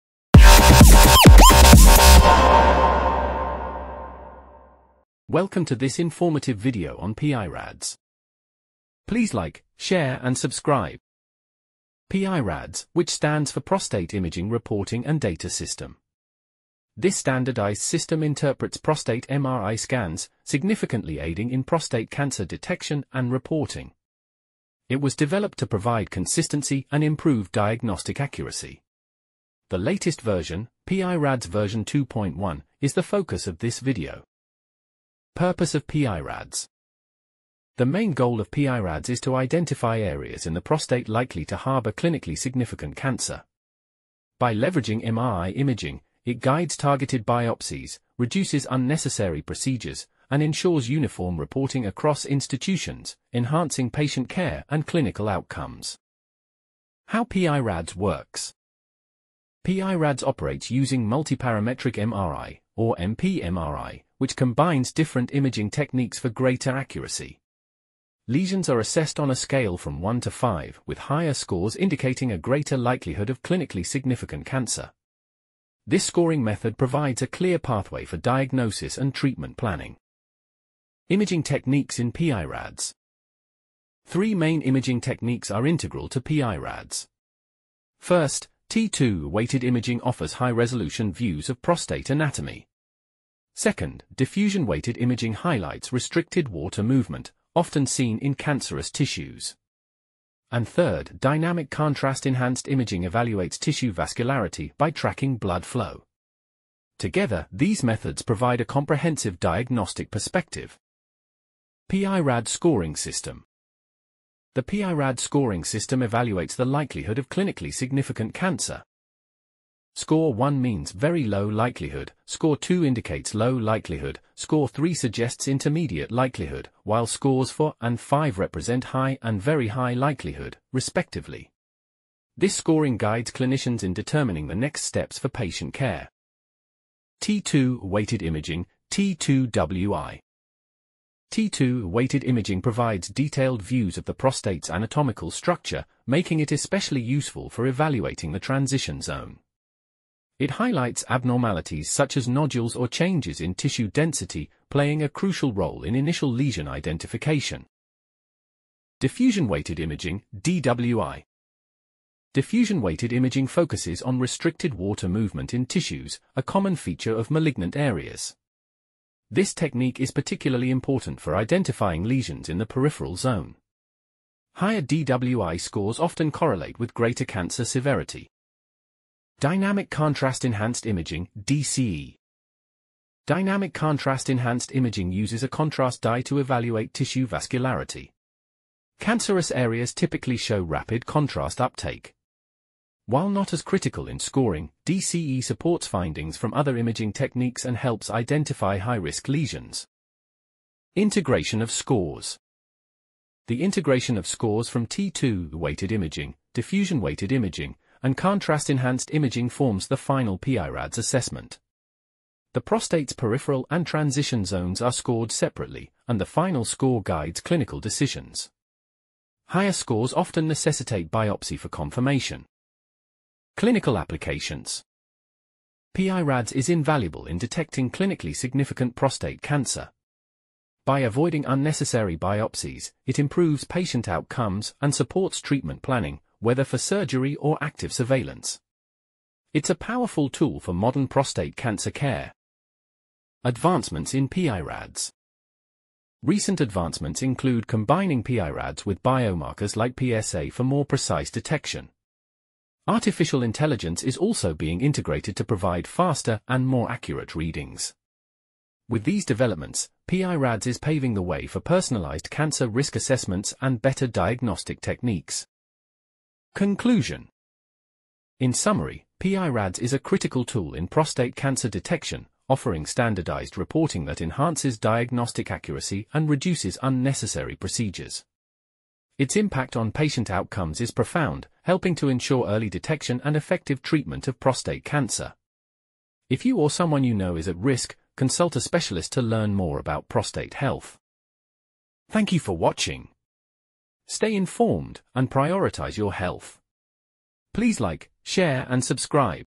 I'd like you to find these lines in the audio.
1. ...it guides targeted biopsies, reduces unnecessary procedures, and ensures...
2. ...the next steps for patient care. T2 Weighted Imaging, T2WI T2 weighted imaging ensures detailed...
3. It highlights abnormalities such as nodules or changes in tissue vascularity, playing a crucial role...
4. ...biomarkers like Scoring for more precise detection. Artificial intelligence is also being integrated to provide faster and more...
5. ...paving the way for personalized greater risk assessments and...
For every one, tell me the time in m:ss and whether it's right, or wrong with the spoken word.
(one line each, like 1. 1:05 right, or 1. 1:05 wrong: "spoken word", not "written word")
1. 0:46 right
2. 2:14 wrong: "provides", not "ensures"
3. 2:30 wrong: "density", not "vascularity"
4. 4:09 wrong: "PSA", not "Scoring"
5. 4:20 wrong: "cancer", not "greater".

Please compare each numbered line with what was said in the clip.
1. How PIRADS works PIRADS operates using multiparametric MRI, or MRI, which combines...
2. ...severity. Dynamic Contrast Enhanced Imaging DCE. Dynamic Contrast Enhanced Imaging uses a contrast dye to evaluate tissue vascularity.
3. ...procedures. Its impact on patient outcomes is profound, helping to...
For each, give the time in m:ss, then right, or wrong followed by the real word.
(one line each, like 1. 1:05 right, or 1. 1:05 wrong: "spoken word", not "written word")
1. 0:57 wrong: "MPMRI", not "MRI"
2. 2:57 right
3. 4:37 right.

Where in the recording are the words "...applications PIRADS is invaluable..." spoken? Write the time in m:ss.
3:43.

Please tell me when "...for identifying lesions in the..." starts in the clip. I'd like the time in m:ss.
2:51.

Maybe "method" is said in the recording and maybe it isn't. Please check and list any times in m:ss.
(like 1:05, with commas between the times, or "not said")
1:16, 1:47.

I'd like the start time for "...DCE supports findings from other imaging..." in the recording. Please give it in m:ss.
3:14.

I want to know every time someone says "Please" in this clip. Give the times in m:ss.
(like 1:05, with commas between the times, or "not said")
0:09, 4:57.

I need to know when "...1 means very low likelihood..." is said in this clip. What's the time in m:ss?
2:00.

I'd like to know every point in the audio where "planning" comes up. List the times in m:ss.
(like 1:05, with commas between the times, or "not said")
1:19, 3:55.